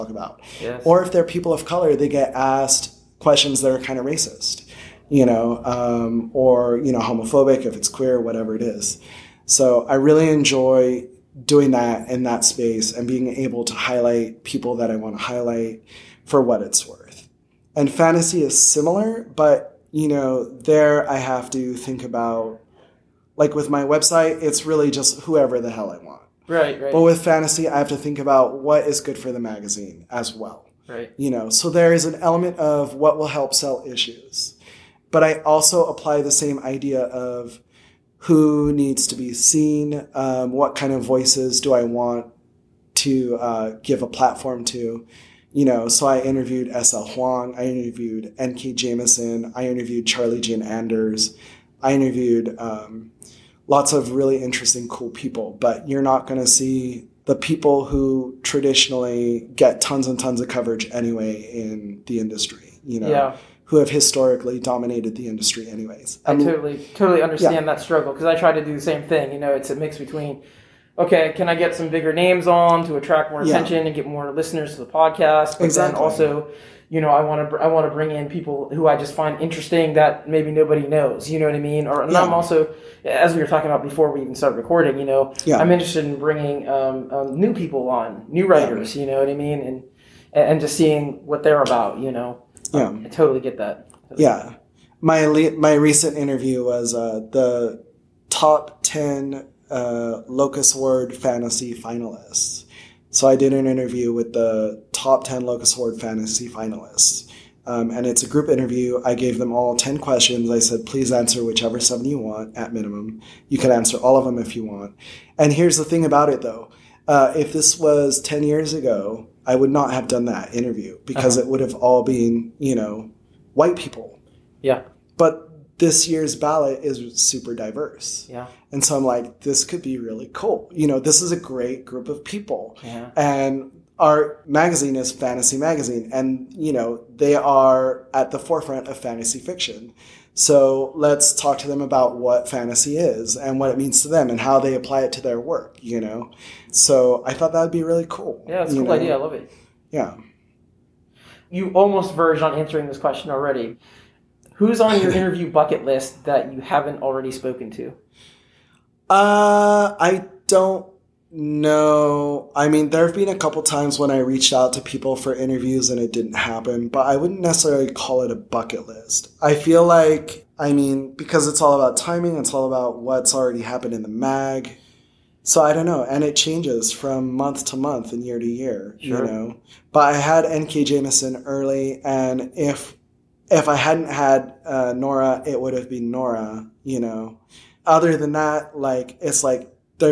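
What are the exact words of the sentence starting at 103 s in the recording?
So I did an interview with the top 10 locus word fantasy finalists.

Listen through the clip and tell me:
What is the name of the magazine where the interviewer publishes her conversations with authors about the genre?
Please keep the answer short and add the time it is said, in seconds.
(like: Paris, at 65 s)
Fantasy Magazine, at 135 s.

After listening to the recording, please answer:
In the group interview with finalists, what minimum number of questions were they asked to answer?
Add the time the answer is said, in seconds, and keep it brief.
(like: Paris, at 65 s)
7, at 111 s.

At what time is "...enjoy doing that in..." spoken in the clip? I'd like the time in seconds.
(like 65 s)
10 s.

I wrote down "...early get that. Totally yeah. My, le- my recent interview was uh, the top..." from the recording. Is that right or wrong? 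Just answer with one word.
wrong.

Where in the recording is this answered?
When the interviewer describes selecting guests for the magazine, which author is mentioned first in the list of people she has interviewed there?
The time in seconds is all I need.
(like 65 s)
46 s.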